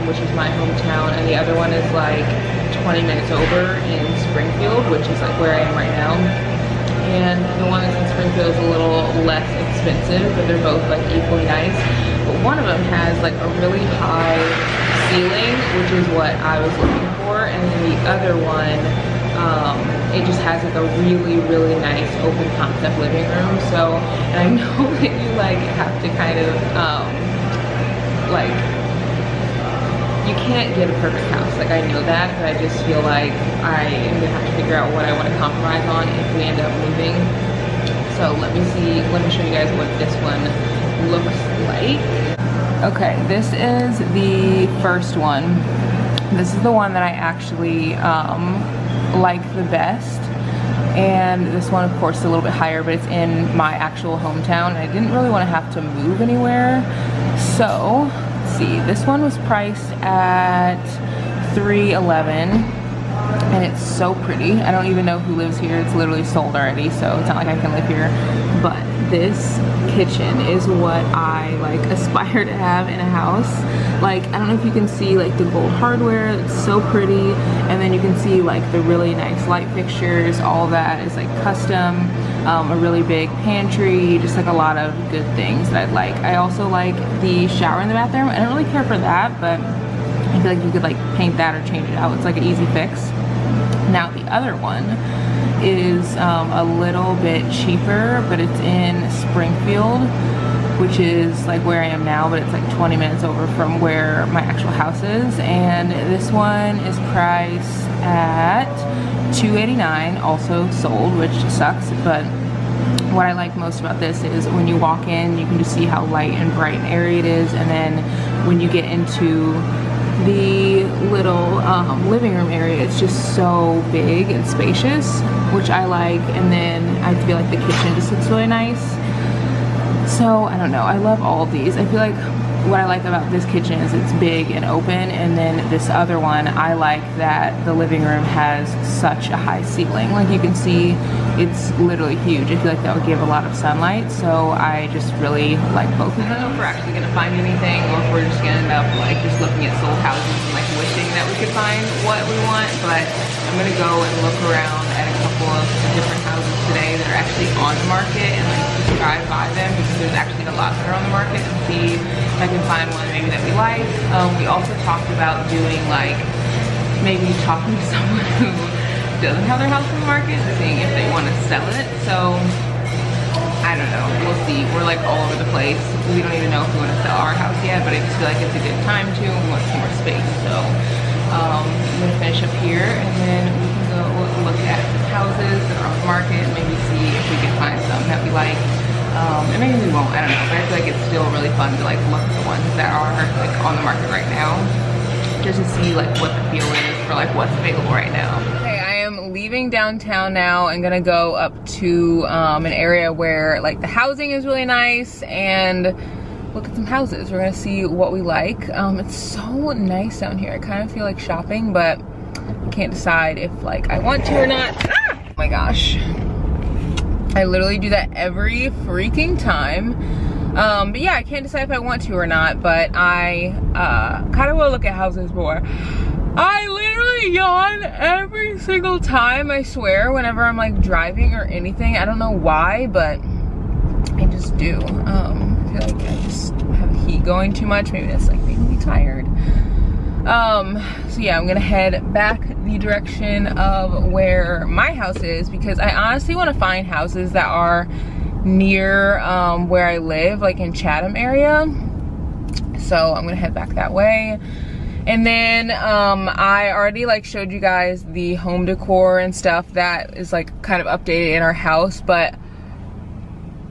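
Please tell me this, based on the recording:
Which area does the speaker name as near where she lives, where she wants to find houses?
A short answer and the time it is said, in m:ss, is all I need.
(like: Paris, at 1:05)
Chatham, at 4:10.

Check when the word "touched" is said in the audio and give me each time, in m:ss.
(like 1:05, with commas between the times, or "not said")
not said.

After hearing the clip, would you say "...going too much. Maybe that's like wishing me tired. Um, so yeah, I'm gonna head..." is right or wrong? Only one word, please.
wrong.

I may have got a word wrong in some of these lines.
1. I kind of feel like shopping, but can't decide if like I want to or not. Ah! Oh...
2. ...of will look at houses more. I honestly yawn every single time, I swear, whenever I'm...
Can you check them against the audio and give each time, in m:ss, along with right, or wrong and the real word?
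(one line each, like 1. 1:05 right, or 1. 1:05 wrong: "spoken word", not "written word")
1. 3:30 right
2. 3:44 wrong: "literally", not "honestly".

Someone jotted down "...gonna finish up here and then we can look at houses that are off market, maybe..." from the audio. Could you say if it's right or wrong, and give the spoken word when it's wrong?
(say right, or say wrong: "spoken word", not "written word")
right.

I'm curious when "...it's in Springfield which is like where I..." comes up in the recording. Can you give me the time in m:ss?
1:38.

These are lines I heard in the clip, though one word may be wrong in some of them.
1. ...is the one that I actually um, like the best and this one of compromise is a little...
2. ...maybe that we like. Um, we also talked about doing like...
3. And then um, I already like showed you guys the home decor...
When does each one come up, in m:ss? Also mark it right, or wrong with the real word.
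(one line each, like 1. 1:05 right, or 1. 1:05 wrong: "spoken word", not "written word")
1. 0:46 wrong: "course", not "compromise"
2. 2:43 right
3. 4:15 right.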